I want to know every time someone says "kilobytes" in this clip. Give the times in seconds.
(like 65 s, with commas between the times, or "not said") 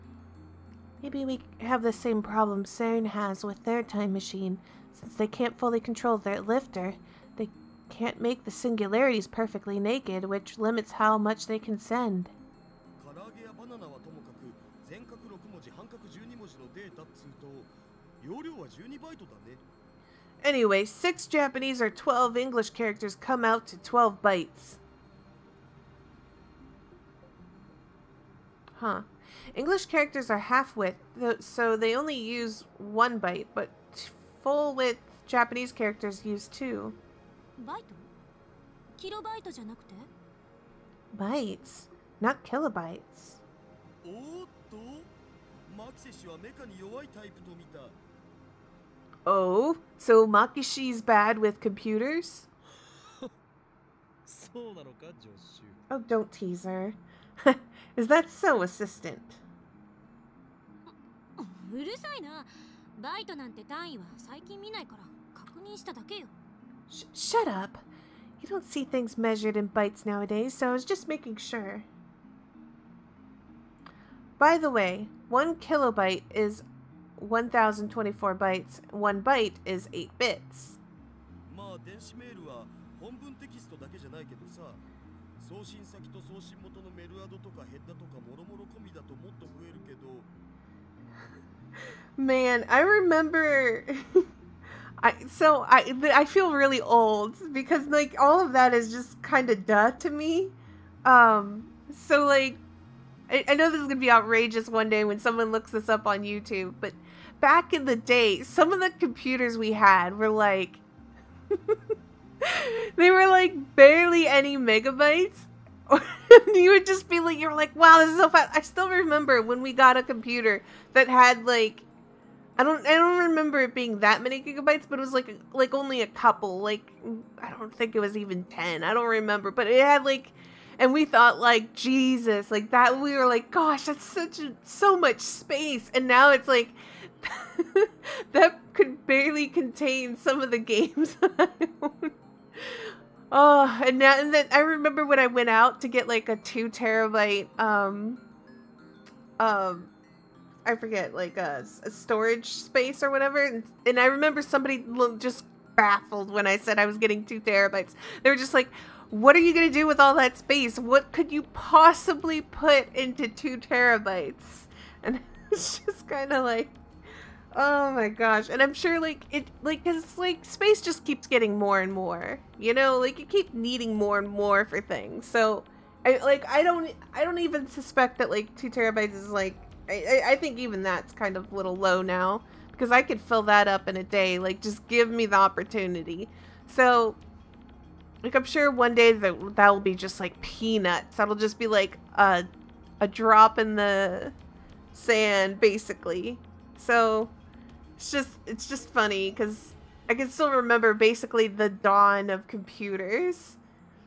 42 s, 75 s.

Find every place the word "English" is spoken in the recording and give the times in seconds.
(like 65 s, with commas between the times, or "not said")
22 s, 29 s.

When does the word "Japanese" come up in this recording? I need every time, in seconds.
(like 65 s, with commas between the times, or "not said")
21 s, 35 s.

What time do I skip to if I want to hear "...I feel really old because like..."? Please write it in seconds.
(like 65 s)
96 s.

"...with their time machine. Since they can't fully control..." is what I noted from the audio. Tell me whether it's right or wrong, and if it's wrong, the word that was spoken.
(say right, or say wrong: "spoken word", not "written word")
right.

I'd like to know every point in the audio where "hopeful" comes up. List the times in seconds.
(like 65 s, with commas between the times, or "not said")
not said.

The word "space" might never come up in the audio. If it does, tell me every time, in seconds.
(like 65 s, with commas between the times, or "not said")
135 s, 152 s, 160 s, 170 s.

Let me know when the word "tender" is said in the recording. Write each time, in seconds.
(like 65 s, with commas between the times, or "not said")
not said.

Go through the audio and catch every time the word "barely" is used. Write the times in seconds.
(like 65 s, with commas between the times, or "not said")
113 s, 139 s.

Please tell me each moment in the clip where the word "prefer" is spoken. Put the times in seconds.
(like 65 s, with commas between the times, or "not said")
not said.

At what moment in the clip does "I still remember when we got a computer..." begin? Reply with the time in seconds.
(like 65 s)
118 s.